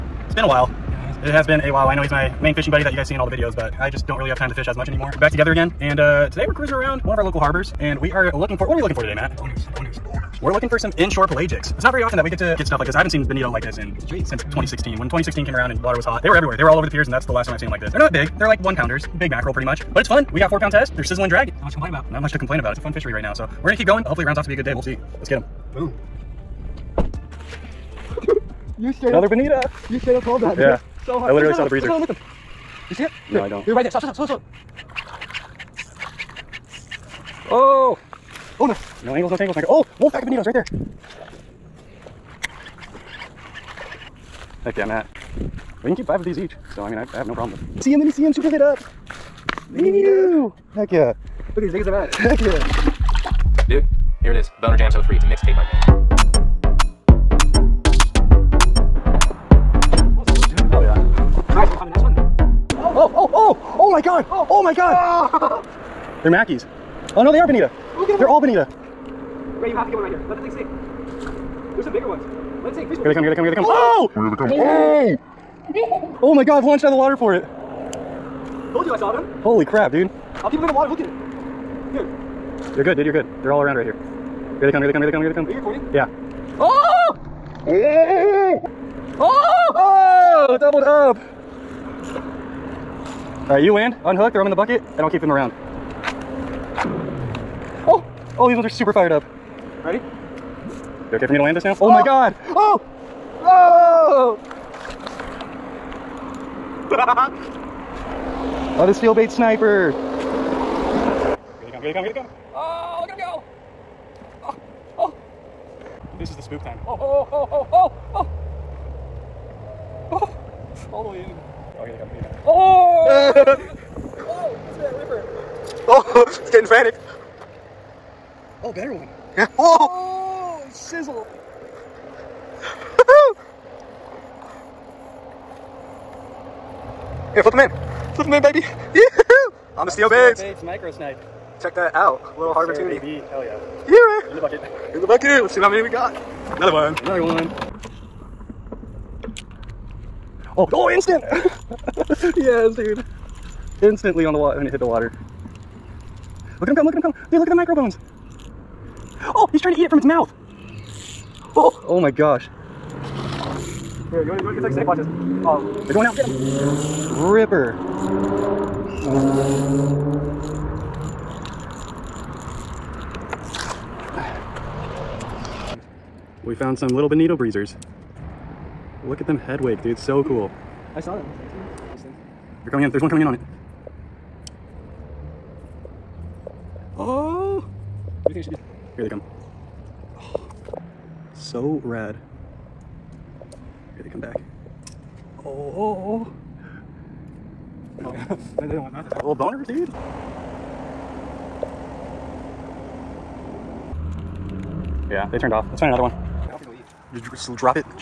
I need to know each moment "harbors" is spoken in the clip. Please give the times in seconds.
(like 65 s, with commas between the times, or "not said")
7 s, 142 s.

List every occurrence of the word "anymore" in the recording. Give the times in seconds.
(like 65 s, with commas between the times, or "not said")
4 s.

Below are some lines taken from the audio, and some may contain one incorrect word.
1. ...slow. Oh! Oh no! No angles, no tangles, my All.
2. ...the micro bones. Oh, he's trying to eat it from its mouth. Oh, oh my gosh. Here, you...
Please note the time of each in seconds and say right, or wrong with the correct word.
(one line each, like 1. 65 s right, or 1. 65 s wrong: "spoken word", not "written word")
1. 34 s wrong: "God", not "All"
2. 157 s right.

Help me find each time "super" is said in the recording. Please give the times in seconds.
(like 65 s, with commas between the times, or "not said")
48 s, 98 s.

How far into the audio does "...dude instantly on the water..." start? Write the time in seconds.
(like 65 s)
152 s.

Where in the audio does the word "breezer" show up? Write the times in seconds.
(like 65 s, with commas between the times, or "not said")
31 s, 177 s.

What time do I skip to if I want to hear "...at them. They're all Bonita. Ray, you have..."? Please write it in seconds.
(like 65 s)
68 s.